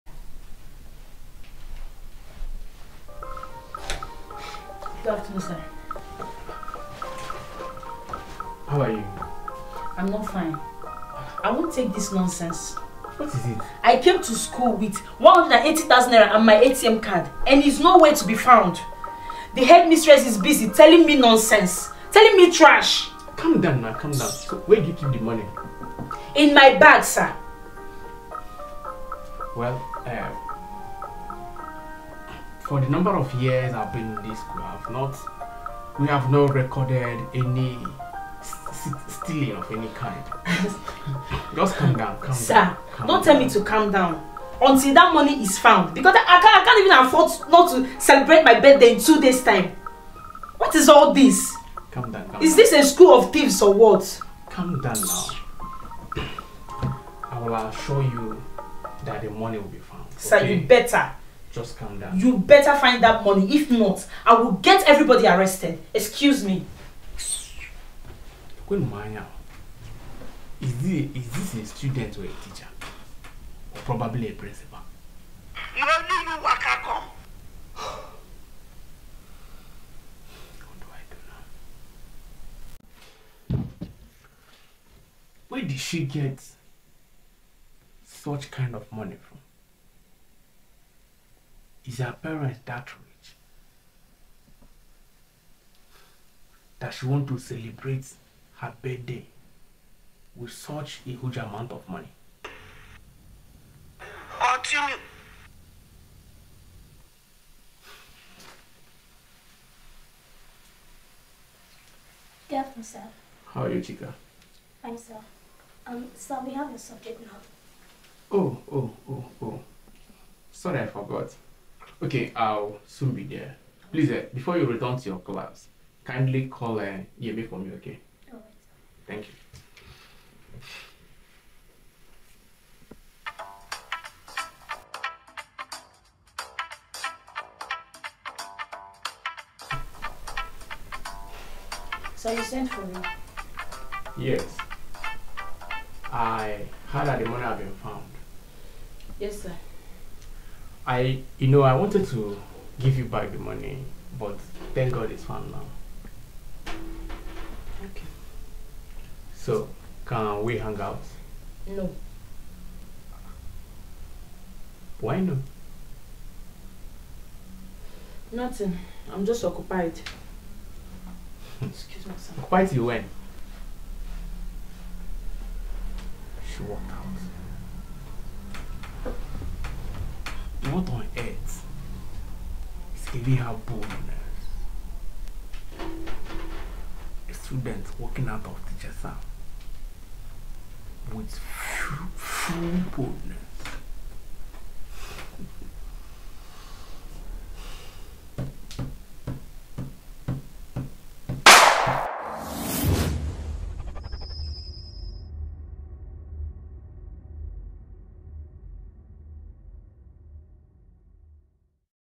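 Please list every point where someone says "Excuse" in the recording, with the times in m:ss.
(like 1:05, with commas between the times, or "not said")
1:05, 2:51.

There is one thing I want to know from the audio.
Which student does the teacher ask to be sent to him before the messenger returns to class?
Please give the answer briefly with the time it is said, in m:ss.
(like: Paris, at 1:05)
Yemi, at 2:07.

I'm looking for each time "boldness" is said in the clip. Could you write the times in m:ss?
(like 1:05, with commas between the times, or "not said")
3:03, 3:12.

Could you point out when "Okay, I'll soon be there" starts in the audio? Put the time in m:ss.
2:02.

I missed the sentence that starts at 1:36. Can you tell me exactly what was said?
That she want to celebrate her birthday with such a huge amount of money.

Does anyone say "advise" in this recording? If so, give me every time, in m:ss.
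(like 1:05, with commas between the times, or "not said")
not said.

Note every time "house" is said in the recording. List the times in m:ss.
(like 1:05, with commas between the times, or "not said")
3:09.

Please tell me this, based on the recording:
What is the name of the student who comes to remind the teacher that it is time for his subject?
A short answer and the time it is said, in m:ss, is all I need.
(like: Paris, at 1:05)
Chica, at 1:53.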